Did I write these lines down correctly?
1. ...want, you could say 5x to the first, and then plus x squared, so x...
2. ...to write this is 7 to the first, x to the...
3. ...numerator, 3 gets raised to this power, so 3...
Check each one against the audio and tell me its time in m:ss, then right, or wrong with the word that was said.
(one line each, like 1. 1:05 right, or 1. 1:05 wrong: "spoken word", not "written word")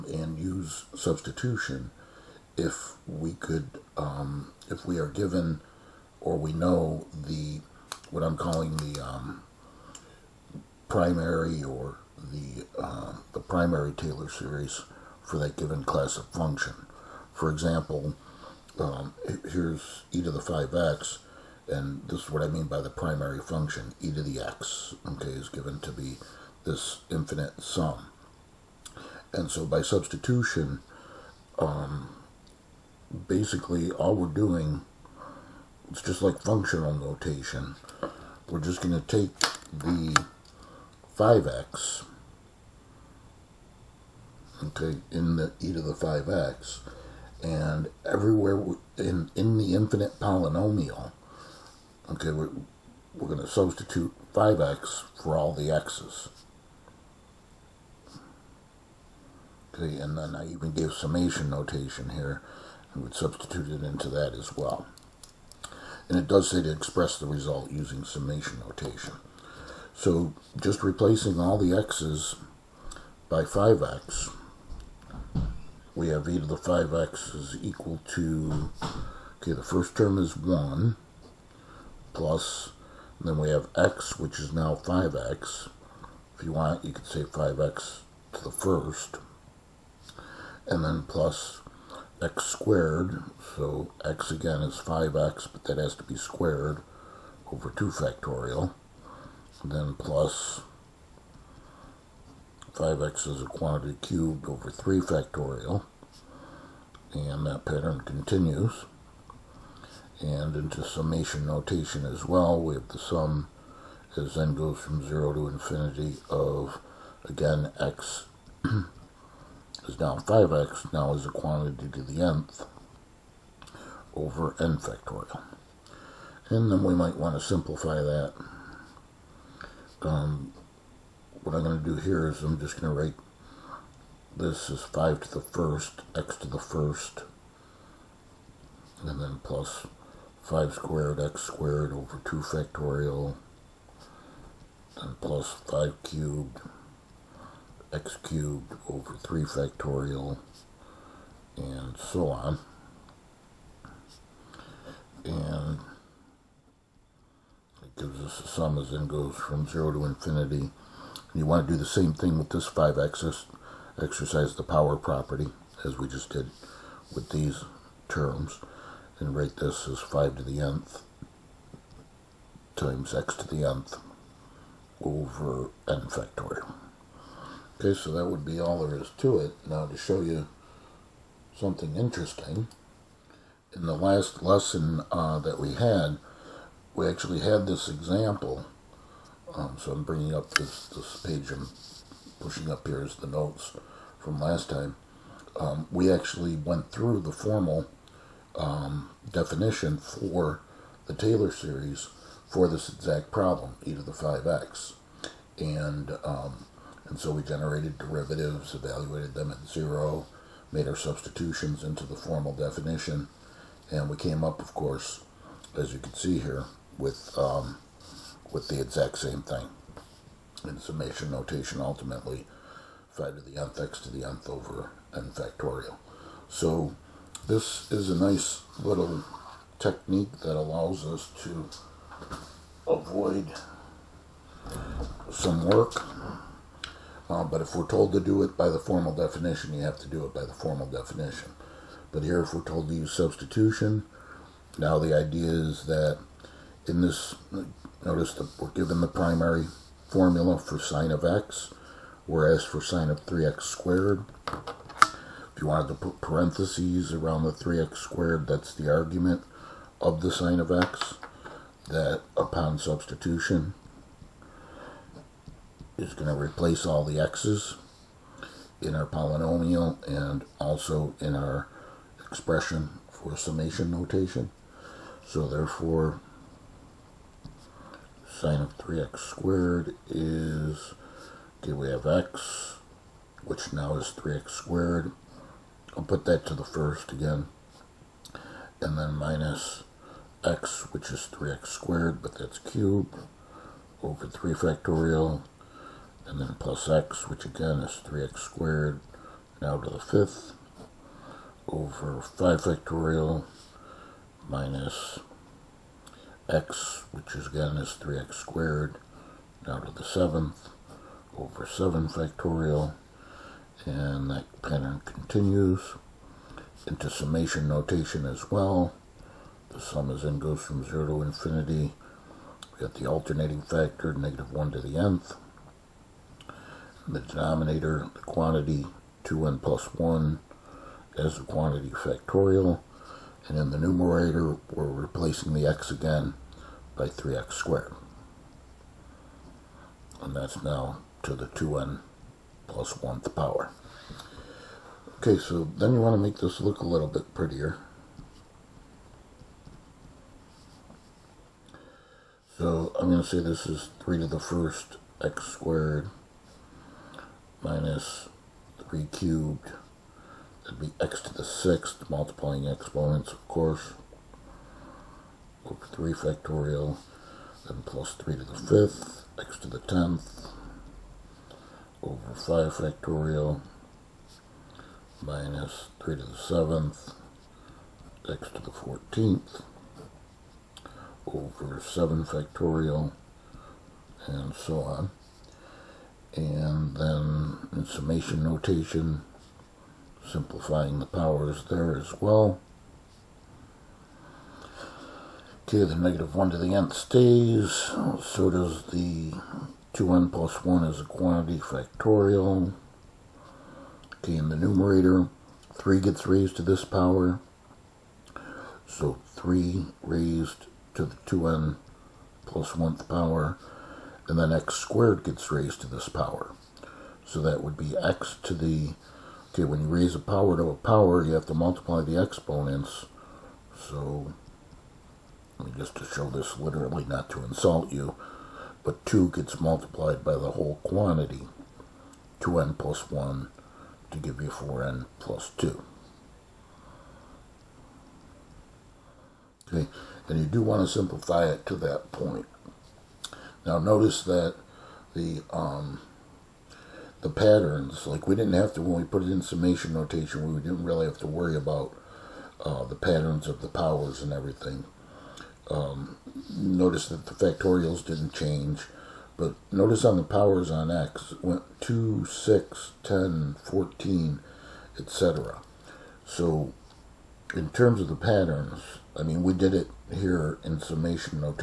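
1. 1:26 right
2. 2:12 wrong: "5", not "7"
3. 6:44 right.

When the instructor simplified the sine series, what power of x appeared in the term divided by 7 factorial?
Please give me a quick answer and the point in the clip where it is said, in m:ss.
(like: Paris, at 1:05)
x to the fourteenth, at 6:18.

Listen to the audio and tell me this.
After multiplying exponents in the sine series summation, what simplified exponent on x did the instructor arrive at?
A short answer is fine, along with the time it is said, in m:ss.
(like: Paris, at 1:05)
4n plus 2, at 7:14.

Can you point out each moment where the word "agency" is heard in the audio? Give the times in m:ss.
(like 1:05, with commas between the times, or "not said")
not said.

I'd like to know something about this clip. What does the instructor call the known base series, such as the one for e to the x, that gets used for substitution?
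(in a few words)
primary Taylor series.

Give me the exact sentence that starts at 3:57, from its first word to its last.
Uh, but if we're told to do it by the formal definition, you have to do it by the formal definition.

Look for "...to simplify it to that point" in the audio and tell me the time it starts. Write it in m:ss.
7:20.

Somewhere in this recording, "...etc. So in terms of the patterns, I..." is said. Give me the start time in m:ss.
7:44.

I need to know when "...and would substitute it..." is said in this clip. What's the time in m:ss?
1:02.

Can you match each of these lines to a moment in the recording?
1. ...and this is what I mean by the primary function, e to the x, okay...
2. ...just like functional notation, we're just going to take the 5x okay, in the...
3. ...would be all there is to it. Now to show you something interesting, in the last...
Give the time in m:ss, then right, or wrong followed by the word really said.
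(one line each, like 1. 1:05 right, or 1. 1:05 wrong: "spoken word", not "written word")
1. 0:21 right
2. 0:36 right
3. 2:58 right.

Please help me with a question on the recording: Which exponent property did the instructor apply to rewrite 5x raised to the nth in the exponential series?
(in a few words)
power property.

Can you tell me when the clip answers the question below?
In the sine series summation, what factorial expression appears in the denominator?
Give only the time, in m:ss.
5:29.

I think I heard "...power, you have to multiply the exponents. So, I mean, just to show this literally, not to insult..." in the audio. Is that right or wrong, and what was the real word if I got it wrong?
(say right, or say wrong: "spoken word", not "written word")
right.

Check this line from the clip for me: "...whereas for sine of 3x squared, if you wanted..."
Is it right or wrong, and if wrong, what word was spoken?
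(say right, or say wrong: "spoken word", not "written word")
right.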